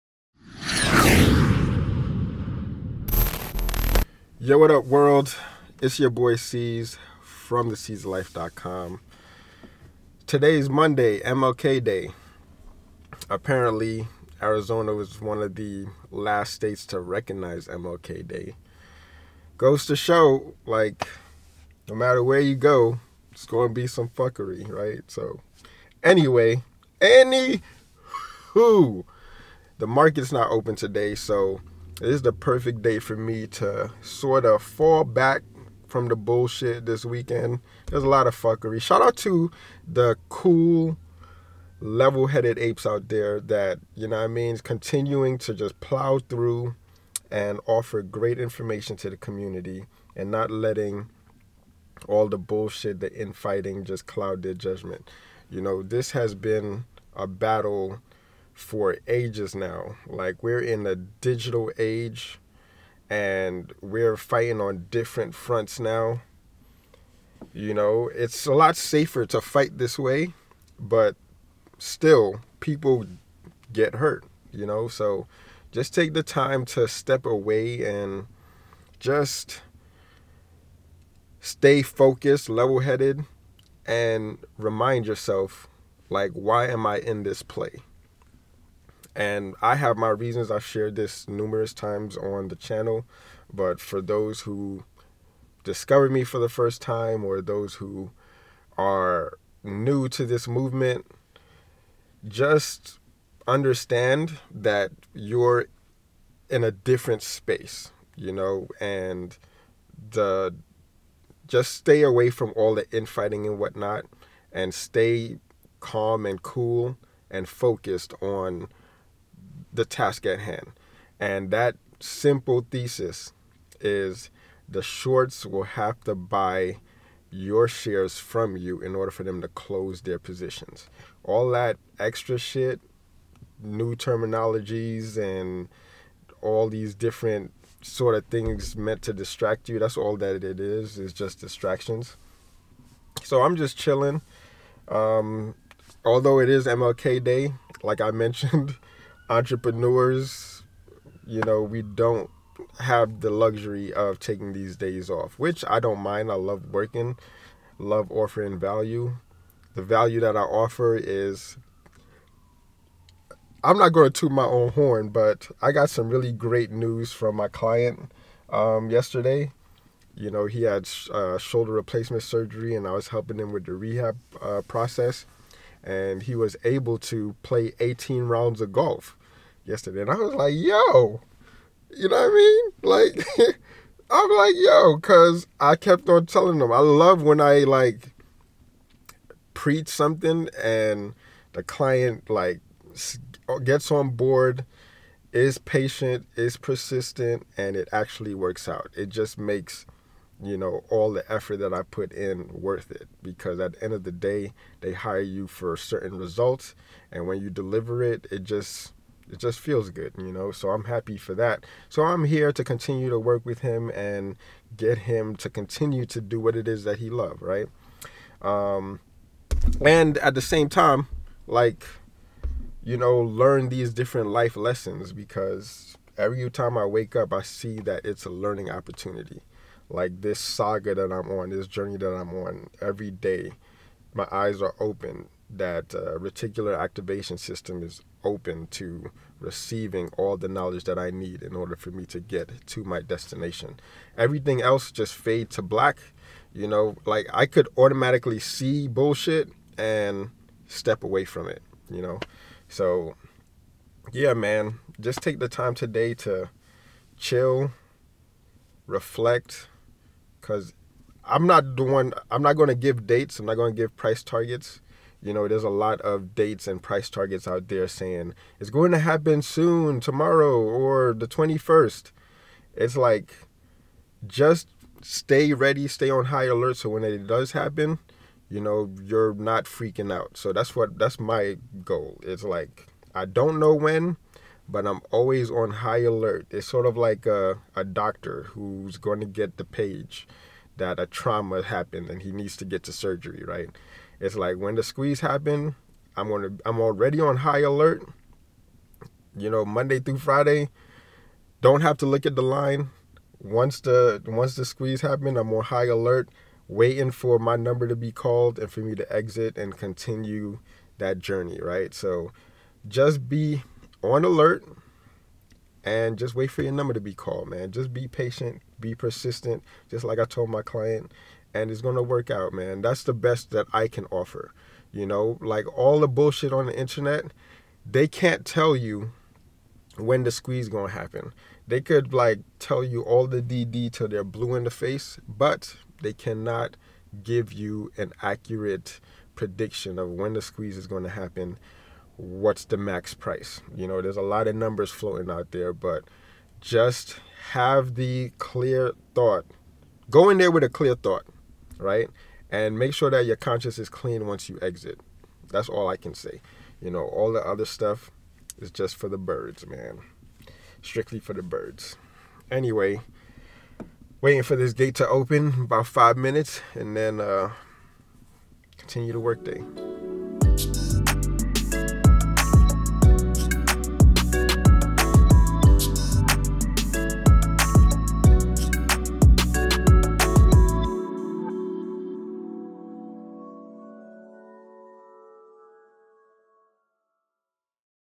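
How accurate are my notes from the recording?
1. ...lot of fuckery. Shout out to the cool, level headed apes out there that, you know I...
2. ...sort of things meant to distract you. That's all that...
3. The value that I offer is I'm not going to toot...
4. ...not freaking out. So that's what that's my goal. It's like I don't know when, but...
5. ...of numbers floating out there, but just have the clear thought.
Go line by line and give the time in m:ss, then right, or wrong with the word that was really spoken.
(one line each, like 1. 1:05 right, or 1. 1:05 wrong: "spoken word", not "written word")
1. 0:38 right
2. 2:17 right
3. 2:39 right
4. 4:39 right
5. 5:44 right.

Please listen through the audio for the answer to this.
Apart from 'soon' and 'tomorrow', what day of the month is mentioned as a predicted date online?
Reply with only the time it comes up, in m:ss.
4:31.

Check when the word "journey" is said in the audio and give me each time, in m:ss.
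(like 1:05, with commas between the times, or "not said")
3:51, 5:11.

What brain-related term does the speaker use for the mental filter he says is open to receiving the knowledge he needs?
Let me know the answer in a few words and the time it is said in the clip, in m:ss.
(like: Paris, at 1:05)
reticular activation system, at 3:56.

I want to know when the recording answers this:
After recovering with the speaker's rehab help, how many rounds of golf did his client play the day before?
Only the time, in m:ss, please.
2:57.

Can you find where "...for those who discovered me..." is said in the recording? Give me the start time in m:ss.
1:33.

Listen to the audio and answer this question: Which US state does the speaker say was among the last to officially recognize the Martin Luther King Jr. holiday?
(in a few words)
Arizona.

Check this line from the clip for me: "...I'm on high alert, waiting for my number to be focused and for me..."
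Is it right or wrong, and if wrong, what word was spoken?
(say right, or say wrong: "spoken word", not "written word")
wrong: "called", not "focused".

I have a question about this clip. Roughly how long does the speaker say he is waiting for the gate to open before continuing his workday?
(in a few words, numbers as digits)
about 5 minutes.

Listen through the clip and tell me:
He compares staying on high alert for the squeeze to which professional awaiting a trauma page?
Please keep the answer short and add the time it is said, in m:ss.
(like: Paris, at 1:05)
a doctor, at 4:47.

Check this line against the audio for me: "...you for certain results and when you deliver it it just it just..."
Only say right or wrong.
right.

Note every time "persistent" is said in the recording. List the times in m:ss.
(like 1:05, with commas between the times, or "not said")
3:16, 5:18.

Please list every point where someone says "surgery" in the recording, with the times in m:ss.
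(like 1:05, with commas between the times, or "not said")
2:52, 4:52.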